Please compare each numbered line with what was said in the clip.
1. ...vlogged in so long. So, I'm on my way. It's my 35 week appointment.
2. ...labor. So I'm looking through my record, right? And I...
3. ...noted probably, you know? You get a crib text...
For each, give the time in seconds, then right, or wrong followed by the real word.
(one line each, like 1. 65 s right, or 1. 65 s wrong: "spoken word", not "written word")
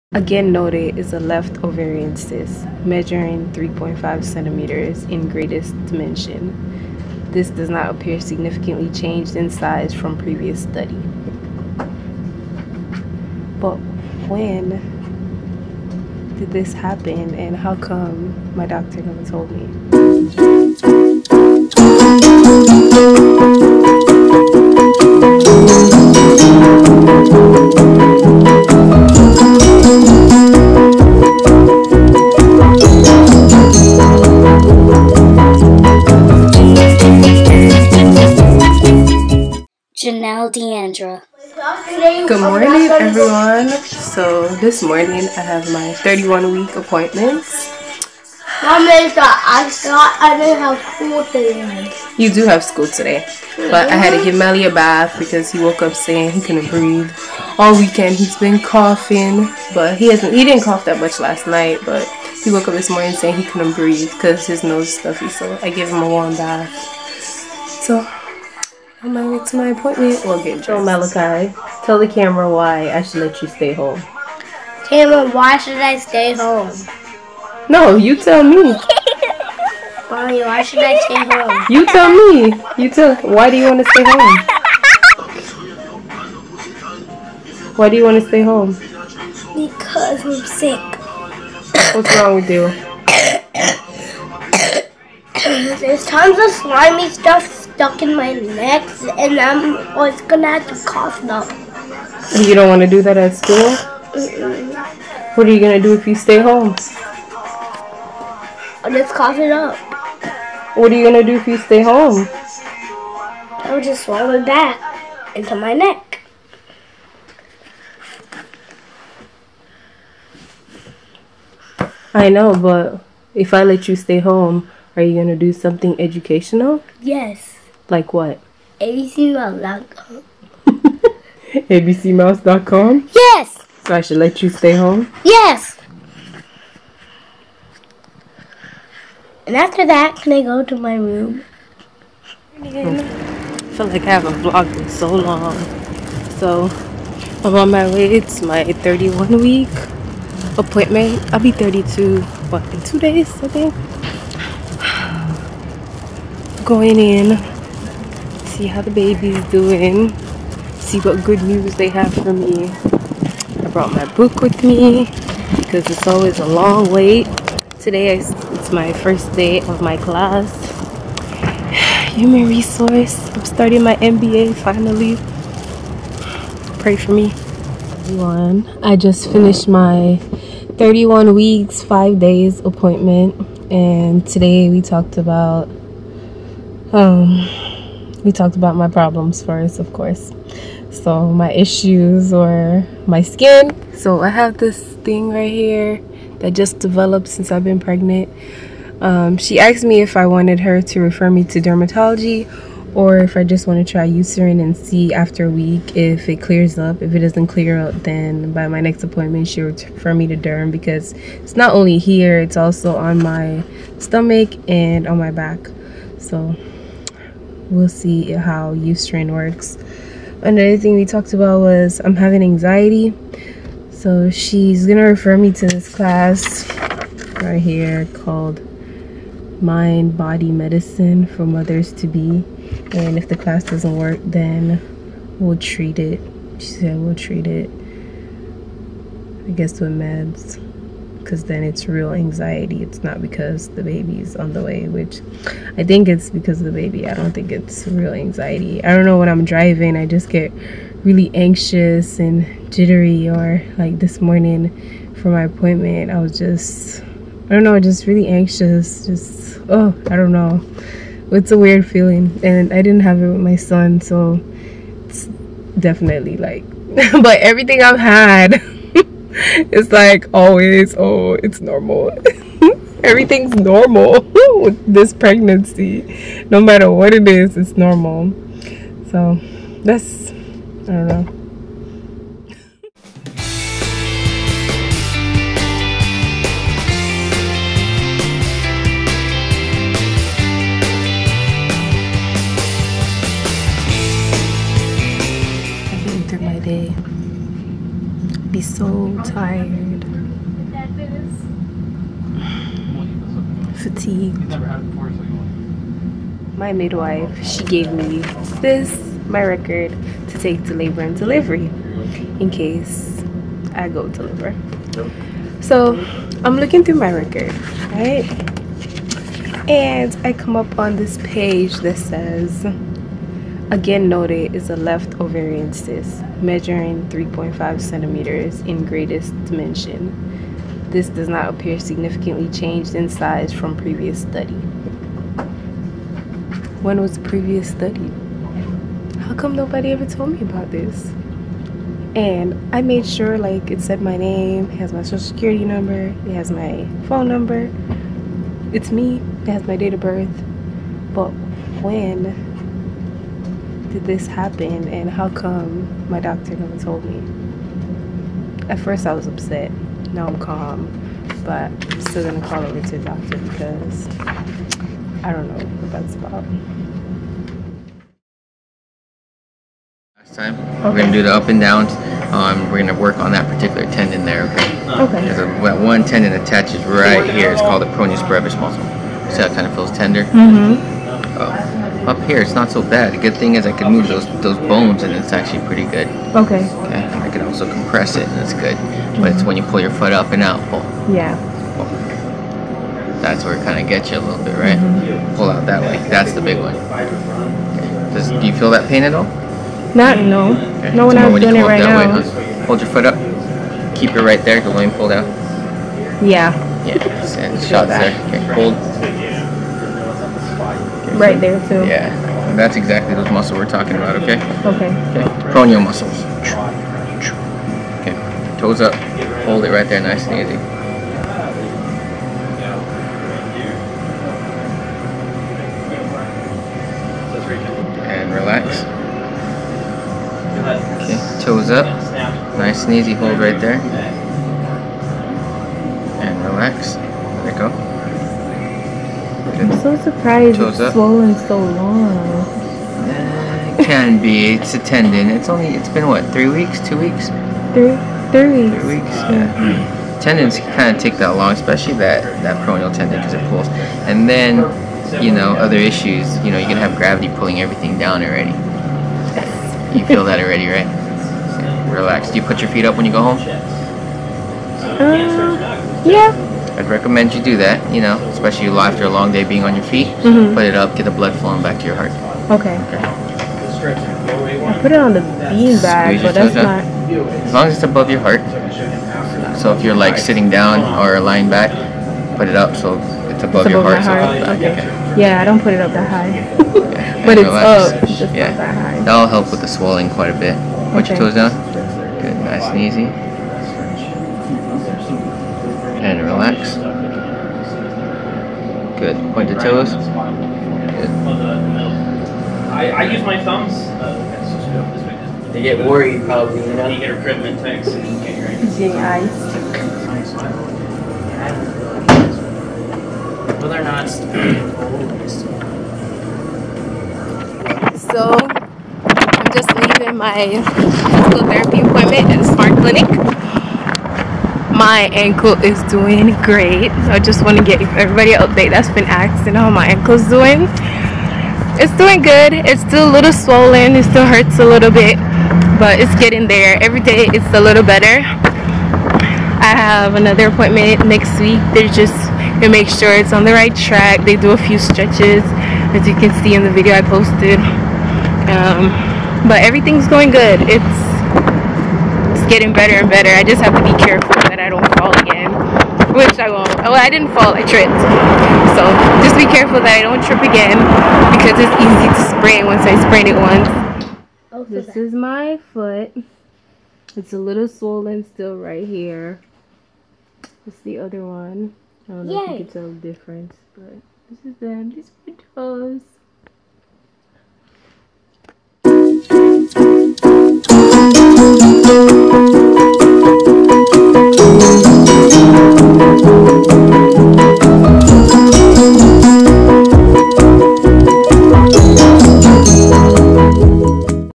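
1. 144 s wrong: "31", not "35"
2. 314 s right
3. 505 s wrong: "worried", not "noted".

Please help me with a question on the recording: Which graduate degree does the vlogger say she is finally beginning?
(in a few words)
MBA.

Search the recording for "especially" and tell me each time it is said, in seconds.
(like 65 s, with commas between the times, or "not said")
451 s, 468 s.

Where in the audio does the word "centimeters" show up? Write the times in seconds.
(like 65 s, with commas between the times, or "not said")
4 s, 327 s.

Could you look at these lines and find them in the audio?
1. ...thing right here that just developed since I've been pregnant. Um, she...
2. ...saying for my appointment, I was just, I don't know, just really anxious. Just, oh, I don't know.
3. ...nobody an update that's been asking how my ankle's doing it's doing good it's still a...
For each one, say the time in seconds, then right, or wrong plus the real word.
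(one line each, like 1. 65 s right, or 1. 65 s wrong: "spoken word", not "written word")
1. 195 s right
2. 254 s wrong: "morning", not "saying"
3. 527 s wrong: "everybody", not "nobody".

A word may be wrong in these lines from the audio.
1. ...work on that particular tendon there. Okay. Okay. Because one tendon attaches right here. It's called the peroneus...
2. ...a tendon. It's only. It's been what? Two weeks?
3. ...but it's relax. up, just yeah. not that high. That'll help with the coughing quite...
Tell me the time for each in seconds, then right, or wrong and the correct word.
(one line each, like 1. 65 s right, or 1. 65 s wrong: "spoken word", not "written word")
1. 372 s right
2. 444 s wrong: "Three", not "Two"
3. 487 s wrong: "swelling", not "coughing".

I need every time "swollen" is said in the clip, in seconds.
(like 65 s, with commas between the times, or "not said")
440 s, 533 s, 567 s.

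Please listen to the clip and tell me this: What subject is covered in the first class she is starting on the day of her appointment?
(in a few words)
Human resource.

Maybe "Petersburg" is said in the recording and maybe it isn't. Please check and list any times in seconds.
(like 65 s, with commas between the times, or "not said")
not said.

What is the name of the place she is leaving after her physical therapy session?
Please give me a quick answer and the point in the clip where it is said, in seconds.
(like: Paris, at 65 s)
Smart Clinic, at 522 s.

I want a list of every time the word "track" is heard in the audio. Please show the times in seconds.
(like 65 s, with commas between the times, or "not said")
543 s.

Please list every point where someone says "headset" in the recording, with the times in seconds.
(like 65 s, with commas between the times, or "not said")
not said.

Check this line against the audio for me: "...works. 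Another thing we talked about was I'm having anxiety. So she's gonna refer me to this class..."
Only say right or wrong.
right.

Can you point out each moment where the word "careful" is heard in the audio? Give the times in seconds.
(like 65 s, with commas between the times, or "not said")
554 s, 559 s.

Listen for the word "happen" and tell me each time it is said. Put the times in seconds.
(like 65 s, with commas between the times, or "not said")
16 s, 354 s.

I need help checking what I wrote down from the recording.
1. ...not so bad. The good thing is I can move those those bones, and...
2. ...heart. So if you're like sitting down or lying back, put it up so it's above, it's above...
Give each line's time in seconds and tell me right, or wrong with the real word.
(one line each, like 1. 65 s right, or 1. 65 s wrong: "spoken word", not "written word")
1. 382 s right
2. 478 s right.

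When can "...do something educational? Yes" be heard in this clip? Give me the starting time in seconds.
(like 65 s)
125 s.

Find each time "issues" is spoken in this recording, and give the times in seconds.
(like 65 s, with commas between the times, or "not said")
191 s, 455 s.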